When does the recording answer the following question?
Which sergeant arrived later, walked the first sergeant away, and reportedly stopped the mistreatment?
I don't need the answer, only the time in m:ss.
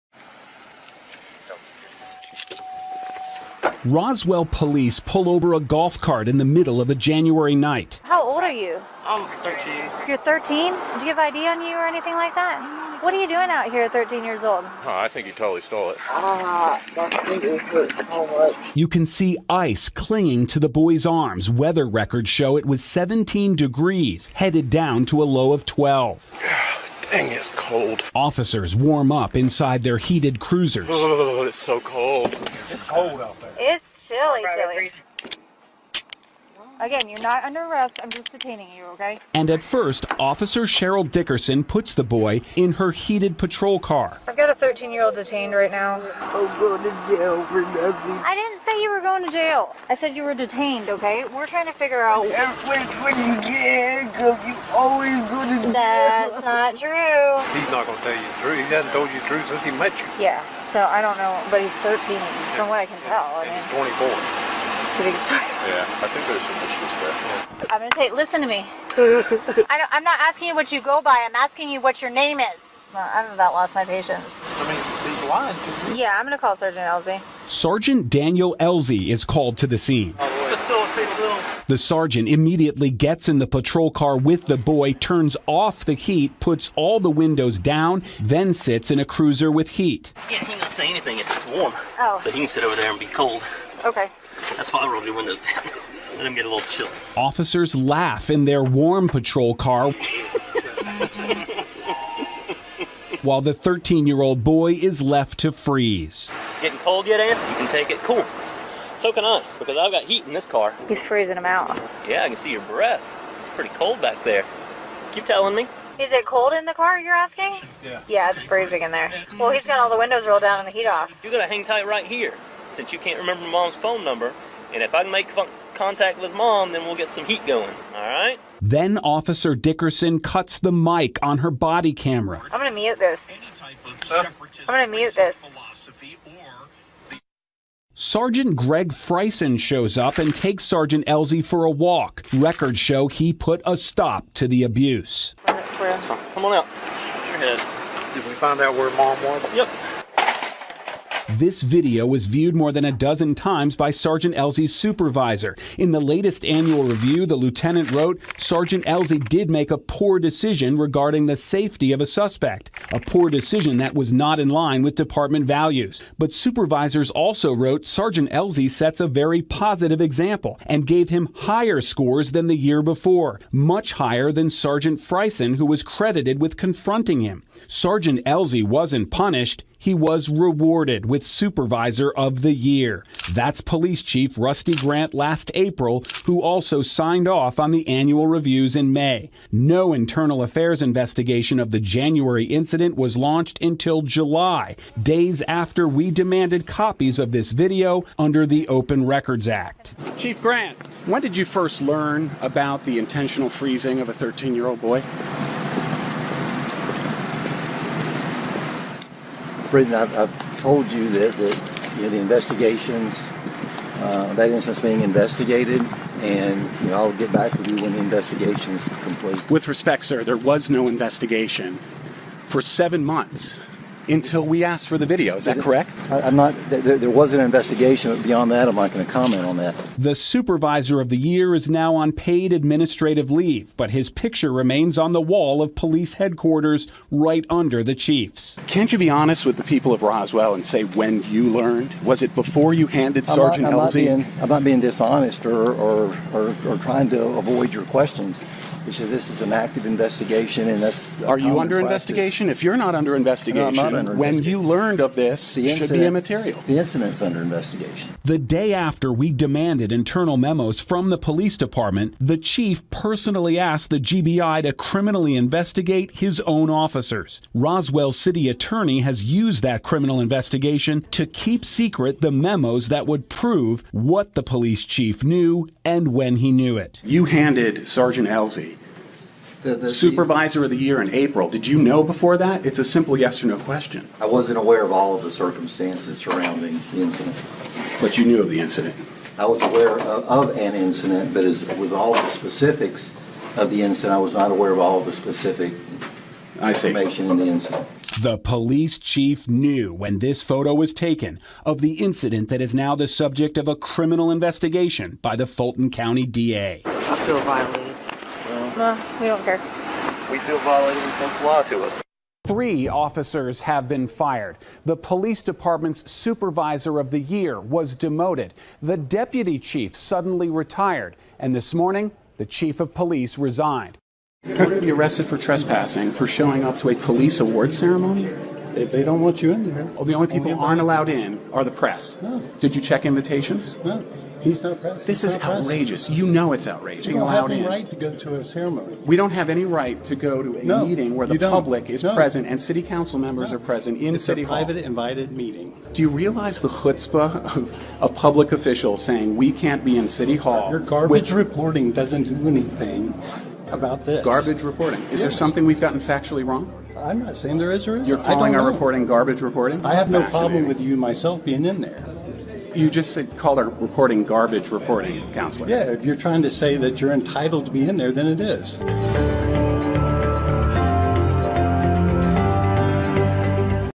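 2:18.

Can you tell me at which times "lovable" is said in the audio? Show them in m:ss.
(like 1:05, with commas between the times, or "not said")
not said.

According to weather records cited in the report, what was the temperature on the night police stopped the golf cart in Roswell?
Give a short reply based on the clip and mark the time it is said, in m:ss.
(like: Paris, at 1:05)
17 degrees, at 0:22.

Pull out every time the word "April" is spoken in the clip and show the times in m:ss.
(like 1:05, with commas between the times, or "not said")
3:05, 4:41.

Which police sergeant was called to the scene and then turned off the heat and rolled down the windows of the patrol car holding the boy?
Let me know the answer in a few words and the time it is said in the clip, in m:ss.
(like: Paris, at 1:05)
Daniel Elzey, at 1:18.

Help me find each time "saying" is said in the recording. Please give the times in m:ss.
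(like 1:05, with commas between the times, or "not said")
5:48, 5:57.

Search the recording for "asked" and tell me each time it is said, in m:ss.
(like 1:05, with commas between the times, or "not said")
3:44, 4:23.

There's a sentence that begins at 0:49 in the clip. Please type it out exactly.
I said you were detained, okay?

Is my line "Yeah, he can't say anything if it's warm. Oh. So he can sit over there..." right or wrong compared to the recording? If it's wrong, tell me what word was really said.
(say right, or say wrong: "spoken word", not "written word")
right.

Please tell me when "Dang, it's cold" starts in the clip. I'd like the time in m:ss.
0:27.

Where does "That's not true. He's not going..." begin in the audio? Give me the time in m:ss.
0:55.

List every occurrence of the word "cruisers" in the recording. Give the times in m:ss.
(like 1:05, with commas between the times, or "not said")
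0:30, 1:29.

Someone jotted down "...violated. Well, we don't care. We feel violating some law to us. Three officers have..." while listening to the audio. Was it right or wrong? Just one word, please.
right.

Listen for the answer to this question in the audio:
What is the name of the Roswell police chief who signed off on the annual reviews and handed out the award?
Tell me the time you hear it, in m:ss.
3:04.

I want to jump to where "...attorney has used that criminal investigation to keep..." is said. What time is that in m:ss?
4:28.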